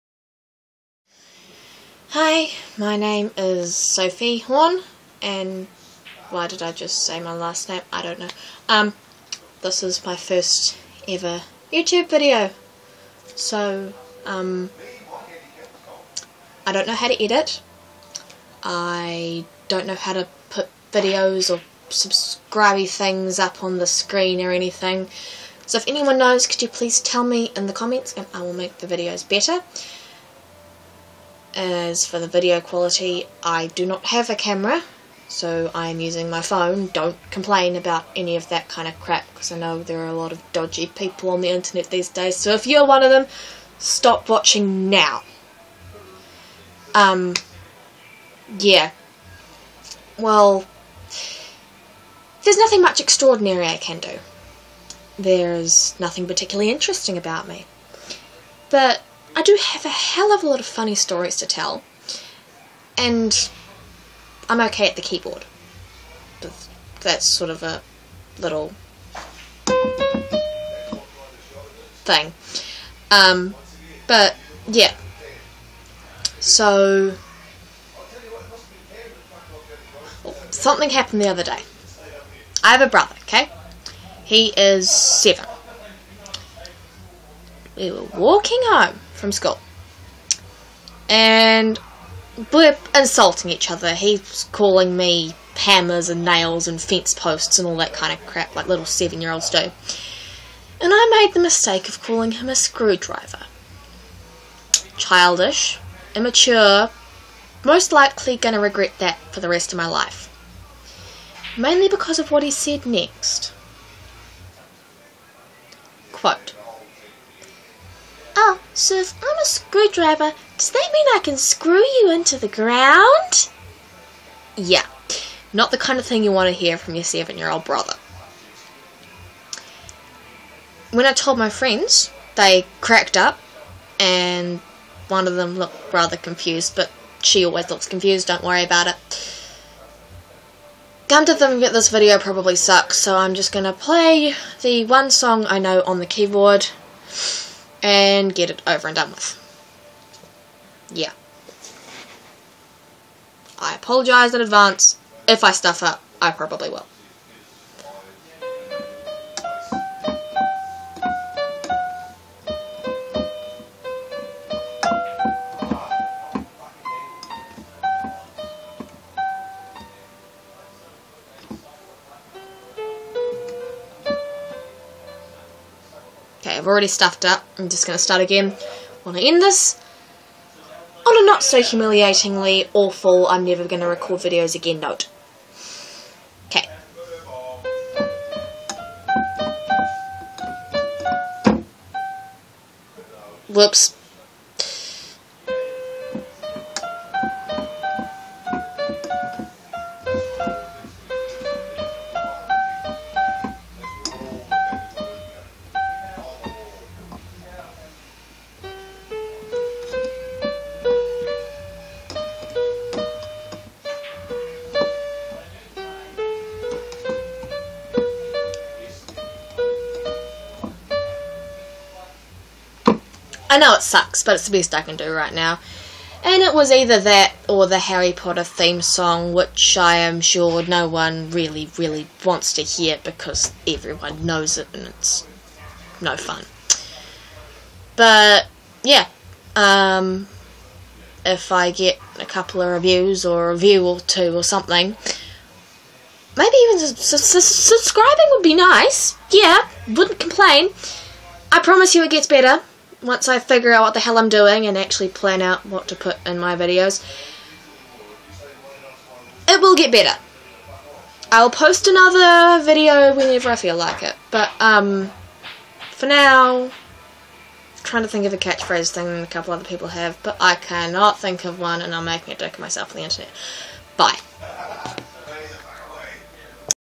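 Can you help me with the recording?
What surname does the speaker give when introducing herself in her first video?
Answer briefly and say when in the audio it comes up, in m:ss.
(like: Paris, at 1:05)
Horn, at 0:04.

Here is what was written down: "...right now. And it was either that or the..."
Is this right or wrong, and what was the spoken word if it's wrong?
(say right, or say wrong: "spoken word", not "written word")
right.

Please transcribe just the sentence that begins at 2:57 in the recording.
I'm just going to start again.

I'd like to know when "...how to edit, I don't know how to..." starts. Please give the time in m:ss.
0:16.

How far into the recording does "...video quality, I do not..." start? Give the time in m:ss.
0:32.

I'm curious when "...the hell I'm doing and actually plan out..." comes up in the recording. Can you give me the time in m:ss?
4:13.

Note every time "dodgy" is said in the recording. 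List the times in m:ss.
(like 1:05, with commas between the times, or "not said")
0:40.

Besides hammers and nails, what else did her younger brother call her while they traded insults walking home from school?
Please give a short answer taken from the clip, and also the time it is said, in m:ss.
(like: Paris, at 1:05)
fence posts, at 1:36.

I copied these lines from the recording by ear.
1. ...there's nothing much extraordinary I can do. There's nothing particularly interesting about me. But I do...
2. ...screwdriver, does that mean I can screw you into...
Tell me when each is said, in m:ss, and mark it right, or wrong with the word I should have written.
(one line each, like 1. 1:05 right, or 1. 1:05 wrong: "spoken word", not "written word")
1. 0:52 right
2. 1:59 right.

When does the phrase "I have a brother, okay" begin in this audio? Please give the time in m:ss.
1:22.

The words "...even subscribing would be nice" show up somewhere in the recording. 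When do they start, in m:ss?
4:06.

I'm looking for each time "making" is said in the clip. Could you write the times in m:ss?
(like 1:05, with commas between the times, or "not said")
4:32.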